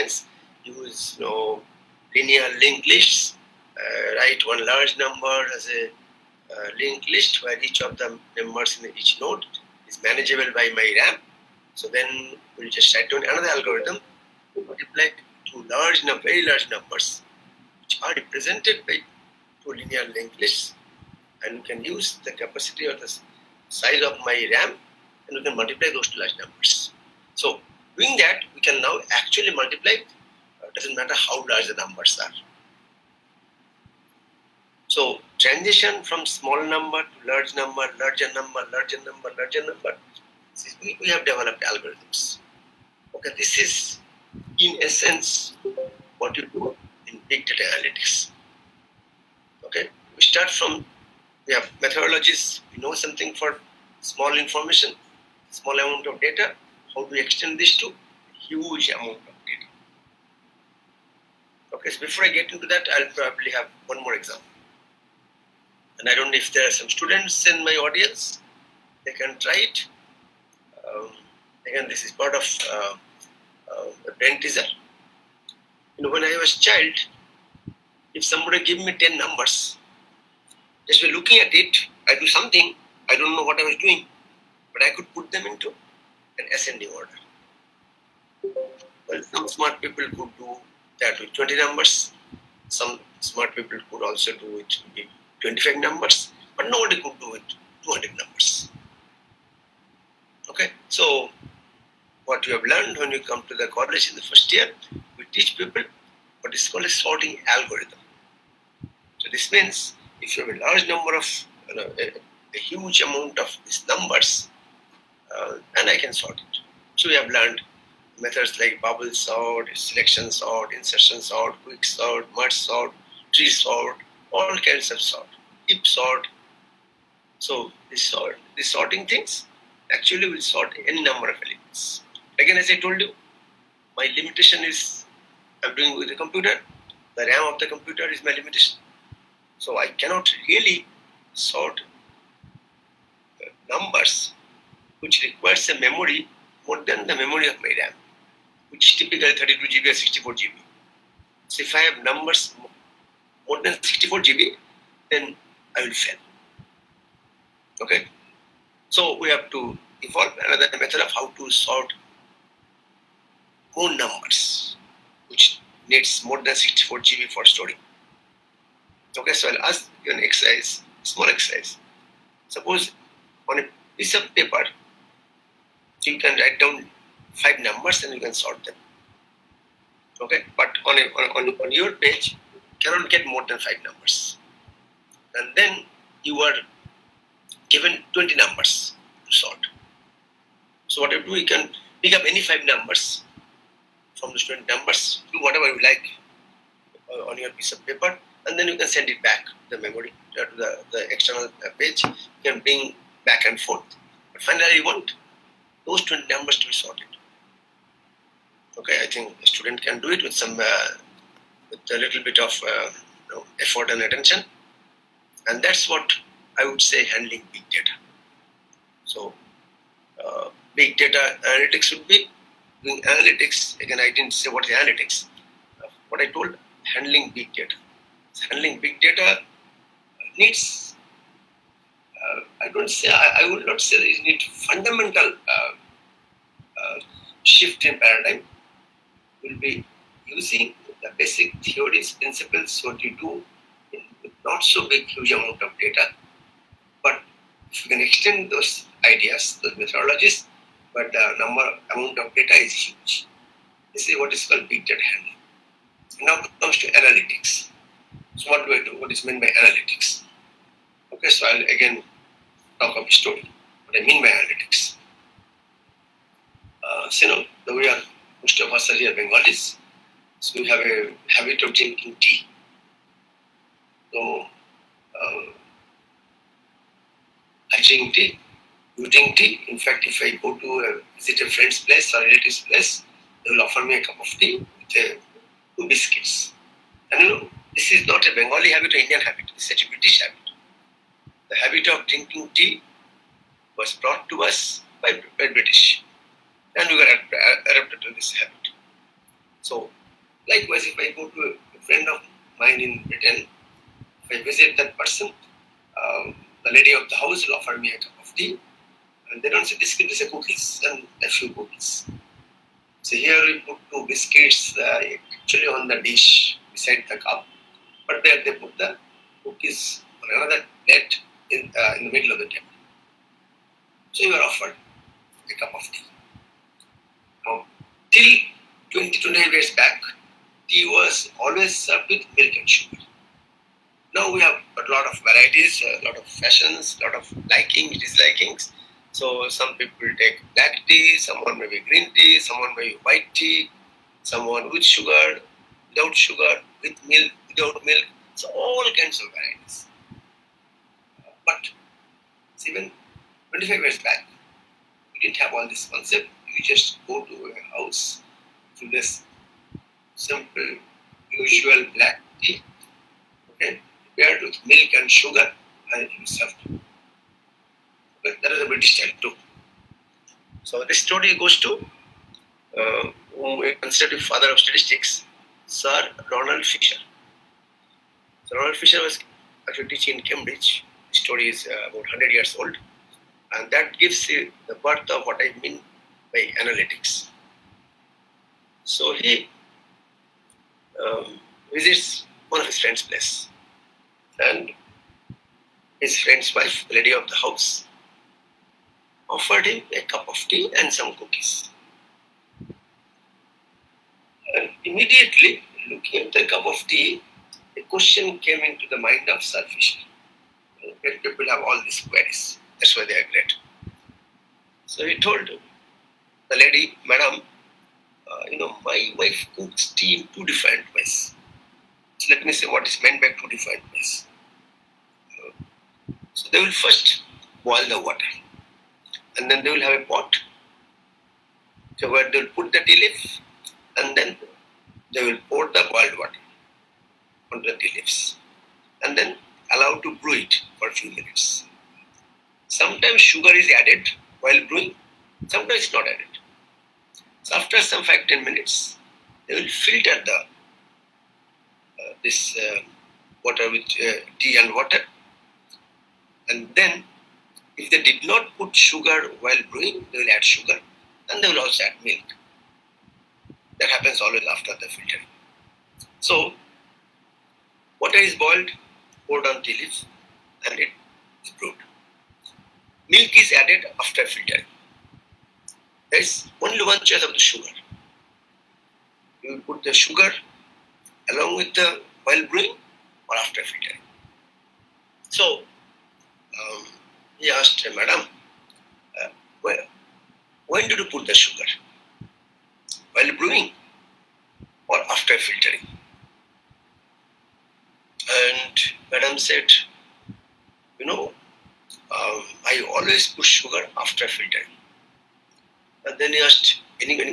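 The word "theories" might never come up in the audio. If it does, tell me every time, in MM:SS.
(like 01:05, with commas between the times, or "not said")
04:01.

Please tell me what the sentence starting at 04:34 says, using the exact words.
So um, I drink tea using tea.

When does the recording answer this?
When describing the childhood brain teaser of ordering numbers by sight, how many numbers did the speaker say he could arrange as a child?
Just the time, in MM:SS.
01:18.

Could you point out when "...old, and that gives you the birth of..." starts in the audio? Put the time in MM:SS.
06:22.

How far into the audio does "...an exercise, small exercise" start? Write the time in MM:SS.
02:50.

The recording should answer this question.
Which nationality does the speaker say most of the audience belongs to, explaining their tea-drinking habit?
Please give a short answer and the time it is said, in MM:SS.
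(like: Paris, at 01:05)
Bengali, at 04:29.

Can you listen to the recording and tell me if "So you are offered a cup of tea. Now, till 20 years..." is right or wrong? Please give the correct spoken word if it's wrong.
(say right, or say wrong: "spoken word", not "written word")
right.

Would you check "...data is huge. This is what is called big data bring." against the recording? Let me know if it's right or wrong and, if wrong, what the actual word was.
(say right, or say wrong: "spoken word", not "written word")
wrong: "handling", not "bring".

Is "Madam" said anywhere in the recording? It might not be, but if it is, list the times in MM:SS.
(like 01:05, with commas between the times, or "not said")
06:57, 08:07, 08:19.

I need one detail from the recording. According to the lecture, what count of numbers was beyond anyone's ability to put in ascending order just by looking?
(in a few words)
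200.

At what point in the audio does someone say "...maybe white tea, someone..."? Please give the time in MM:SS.
05:42.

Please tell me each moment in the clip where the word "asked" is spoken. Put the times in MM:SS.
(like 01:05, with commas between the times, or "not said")
08:07, 08:26.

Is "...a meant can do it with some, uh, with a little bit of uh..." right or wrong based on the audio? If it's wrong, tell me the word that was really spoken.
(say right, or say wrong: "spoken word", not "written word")
wrong: "student", not "meant".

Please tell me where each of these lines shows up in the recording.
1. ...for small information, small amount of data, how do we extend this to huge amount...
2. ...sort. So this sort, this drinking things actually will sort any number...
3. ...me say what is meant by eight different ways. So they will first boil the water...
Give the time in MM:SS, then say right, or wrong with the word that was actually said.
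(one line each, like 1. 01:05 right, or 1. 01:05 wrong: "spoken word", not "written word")
1. 00:53 right
2. 02:05 wrong: "sorting", not "drinking"
3. 07:02 wrong: "two", not "eight".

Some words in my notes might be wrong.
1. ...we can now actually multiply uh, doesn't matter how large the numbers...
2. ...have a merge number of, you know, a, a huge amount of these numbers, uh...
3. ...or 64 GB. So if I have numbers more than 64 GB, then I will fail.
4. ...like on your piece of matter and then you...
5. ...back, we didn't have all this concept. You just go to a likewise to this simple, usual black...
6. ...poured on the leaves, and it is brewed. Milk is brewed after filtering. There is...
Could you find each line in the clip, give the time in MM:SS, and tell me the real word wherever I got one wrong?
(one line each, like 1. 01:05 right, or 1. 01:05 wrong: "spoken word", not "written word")
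1. 00:28 right
2. 01:50 wrong: "large", not "merge"
3. 02:29 right
4. 03:15 wrong: "paper", not "matter"
5. 05:53 wrong: "house", not "likewise"
6. 07:49 wrong: "added", not "brewed".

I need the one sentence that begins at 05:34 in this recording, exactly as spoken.
Now we have a lot of varieties, a lot of fashions, a lot of liking, dislikings.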